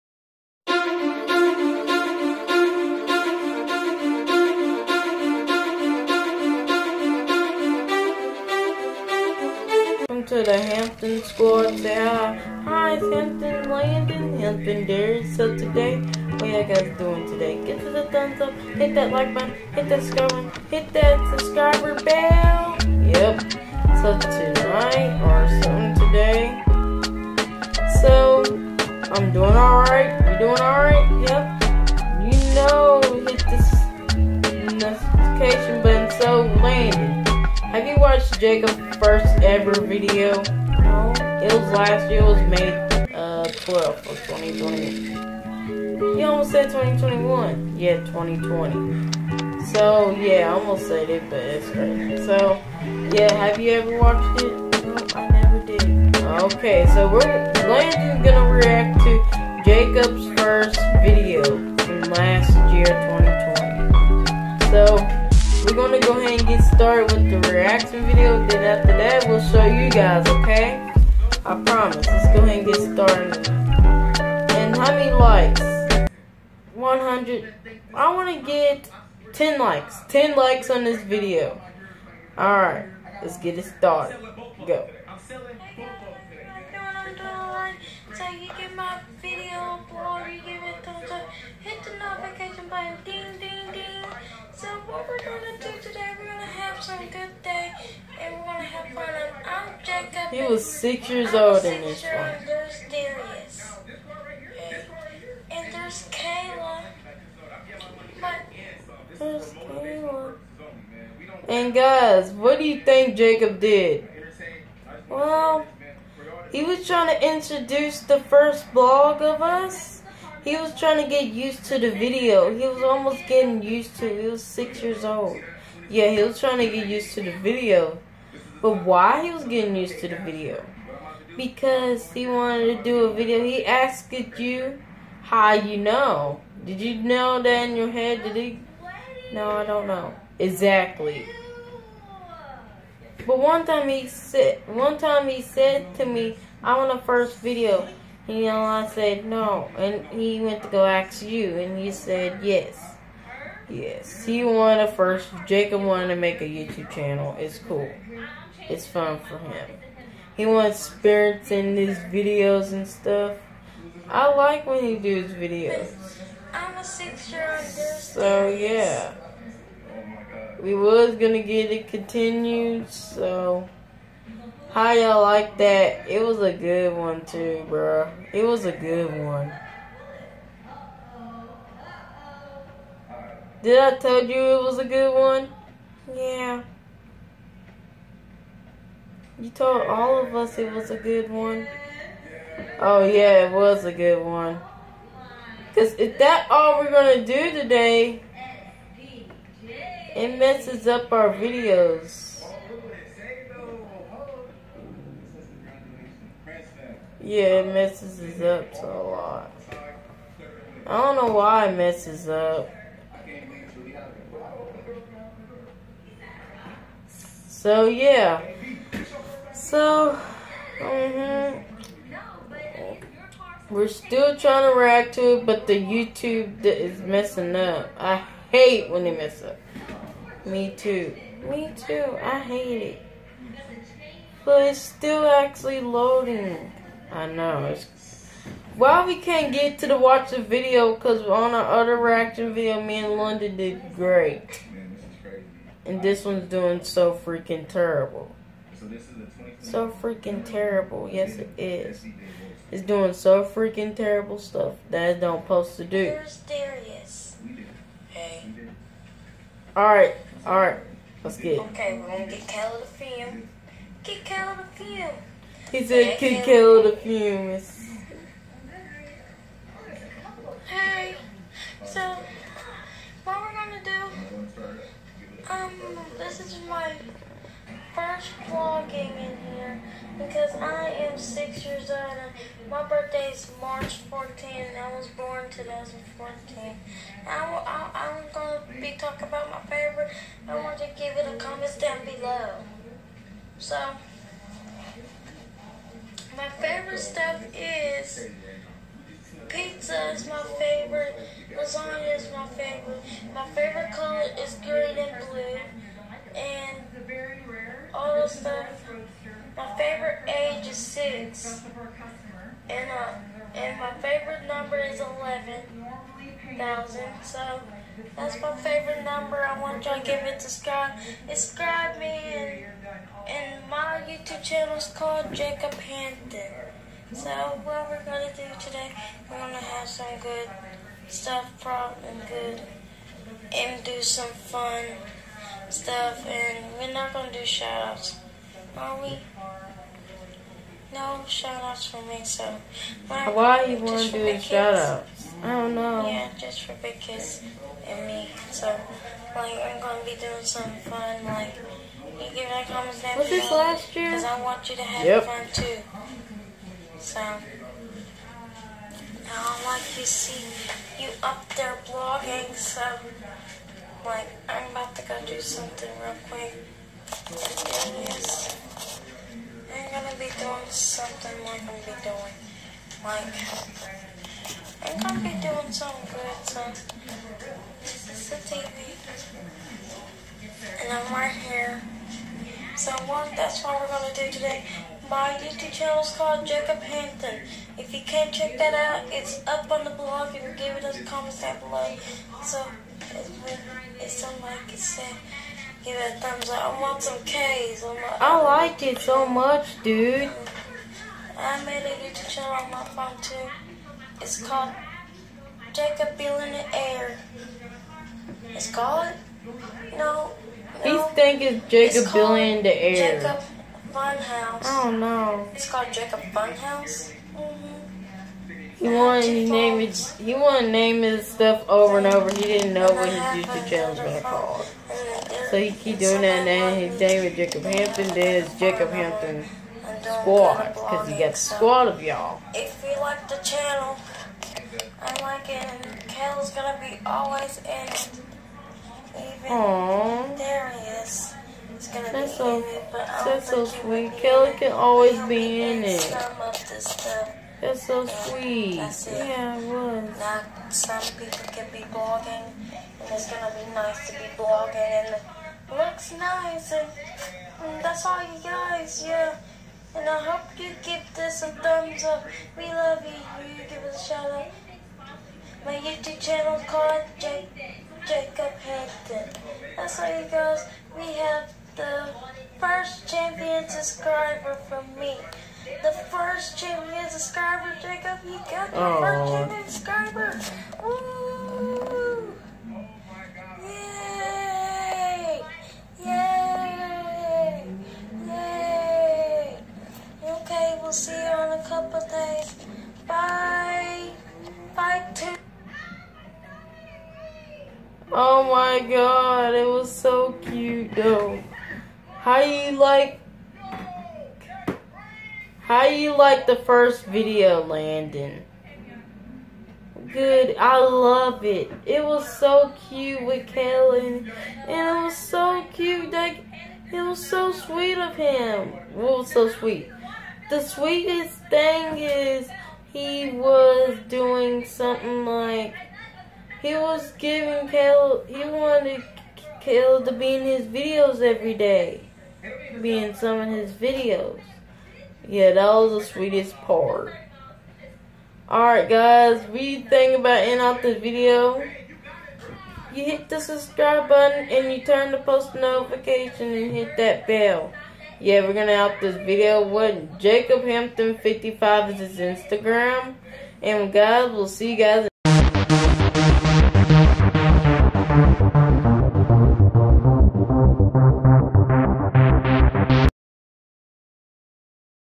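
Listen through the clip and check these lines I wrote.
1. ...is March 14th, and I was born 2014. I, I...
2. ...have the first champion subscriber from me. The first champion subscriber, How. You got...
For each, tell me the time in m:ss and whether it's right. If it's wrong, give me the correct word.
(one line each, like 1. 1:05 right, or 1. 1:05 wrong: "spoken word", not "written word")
1. 4:43 right
2. 7:51 wrong: "Jacob", not "How".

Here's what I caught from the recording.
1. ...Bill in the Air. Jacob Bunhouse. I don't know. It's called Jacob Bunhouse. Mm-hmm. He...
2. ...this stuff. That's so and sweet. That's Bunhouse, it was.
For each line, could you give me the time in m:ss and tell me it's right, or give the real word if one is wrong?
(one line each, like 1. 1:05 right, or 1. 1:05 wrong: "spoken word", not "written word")
1. 6:52 right
2. 7:26 wrong: "Yeah", not "Bunhouse".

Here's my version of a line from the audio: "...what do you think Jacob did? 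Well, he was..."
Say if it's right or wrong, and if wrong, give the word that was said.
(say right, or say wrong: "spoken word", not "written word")
right.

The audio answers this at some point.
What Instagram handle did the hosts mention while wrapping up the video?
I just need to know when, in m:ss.
9:10.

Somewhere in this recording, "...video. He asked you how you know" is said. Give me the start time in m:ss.
2:13.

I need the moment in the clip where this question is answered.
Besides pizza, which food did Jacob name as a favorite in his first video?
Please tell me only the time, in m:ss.
5:01.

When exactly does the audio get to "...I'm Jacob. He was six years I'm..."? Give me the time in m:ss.
1:39.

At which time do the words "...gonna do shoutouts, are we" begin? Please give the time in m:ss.
5:37.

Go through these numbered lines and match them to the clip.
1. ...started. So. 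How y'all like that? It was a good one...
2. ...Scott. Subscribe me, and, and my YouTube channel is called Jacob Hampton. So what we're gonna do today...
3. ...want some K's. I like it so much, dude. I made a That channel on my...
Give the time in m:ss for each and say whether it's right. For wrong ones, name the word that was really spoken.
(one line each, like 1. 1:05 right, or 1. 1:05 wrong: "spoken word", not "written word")
1. 2:51 wrong: "continued", not "started"
2. 5:20 right
3. 6:36 wrong: "YouTube", not "That".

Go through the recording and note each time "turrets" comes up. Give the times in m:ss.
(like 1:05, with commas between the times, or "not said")
not said.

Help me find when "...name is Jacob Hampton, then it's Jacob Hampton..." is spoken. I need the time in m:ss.
7:06.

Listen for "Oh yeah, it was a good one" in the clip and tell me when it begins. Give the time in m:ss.
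3:12.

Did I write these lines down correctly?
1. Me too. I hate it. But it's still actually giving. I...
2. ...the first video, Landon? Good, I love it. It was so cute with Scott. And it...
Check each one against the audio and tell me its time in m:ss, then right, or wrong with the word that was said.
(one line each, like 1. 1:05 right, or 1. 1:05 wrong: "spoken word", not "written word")
1. 3:51 wrong: "loading", not "giving"
2. 8:26 wrong: "Kellen", not "Scott".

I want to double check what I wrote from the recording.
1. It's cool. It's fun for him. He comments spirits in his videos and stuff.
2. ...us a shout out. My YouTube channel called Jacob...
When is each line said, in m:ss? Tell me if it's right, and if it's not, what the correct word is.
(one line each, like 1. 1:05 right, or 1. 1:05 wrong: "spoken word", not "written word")
1. 2:37 wrong: "wants", not "comments"
2. 7:43 right.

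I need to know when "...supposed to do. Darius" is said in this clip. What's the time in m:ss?
4:15.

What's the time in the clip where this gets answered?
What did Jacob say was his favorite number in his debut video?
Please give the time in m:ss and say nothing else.
5:14.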